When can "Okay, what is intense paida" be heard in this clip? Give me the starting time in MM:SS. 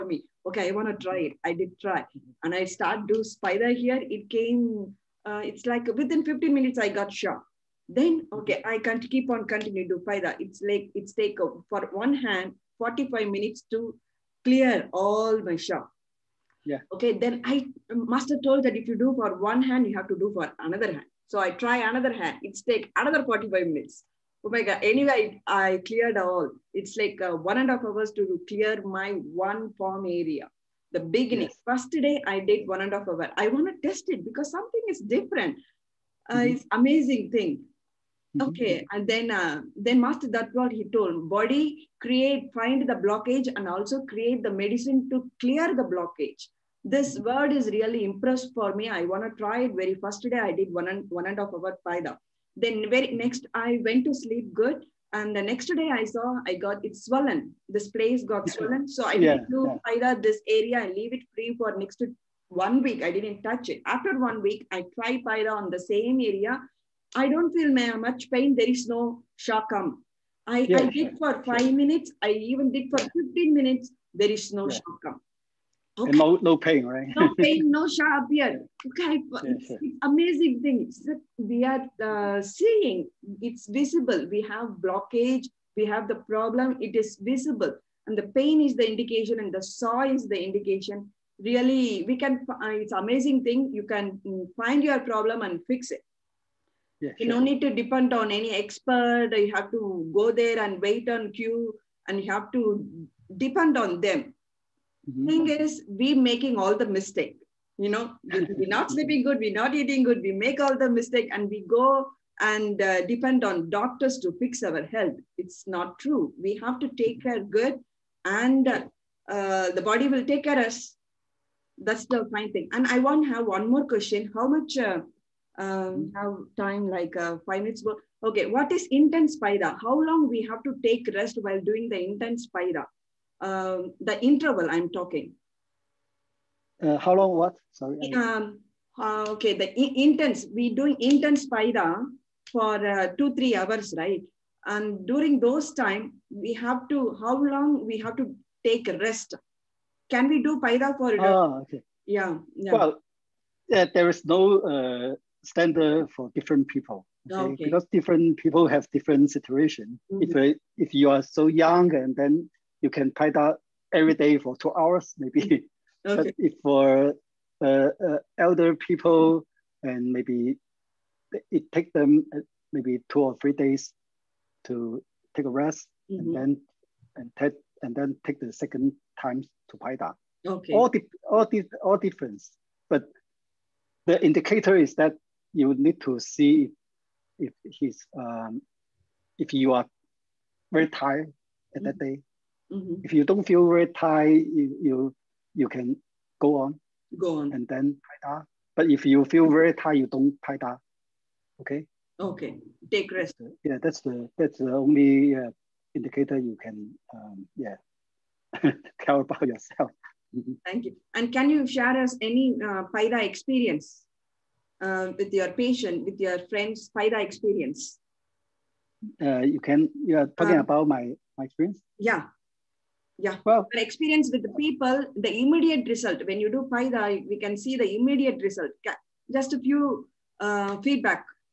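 02:08.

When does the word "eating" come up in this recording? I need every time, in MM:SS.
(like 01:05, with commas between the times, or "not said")
01:49.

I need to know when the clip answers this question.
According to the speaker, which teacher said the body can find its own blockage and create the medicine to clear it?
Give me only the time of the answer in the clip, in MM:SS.
00:39.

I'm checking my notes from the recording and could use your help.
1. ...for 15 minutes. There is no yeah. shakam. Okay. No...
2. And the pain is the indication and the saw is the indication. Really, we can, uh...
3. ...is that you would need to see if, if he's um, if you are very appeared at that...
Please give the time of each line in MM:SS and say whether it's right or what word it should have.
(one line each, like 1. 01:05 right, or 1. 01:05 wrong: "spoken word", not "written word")
1. 01:12 right
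2. 01:28 right
3. 03:04 wrong: "tired", not "appeared".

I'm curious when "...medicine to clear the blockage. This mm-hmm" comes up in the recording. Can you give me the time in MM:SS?
00:44.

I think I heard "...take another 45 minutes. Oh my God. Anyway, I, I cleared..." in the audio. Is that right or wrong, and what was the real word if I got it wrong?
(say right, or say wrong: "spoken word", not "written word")
right.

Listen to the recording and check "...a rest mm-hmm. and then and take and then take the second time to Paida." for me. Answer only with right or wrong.
right.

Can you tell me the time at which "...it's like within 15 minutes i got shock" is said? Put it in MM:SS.
00:05.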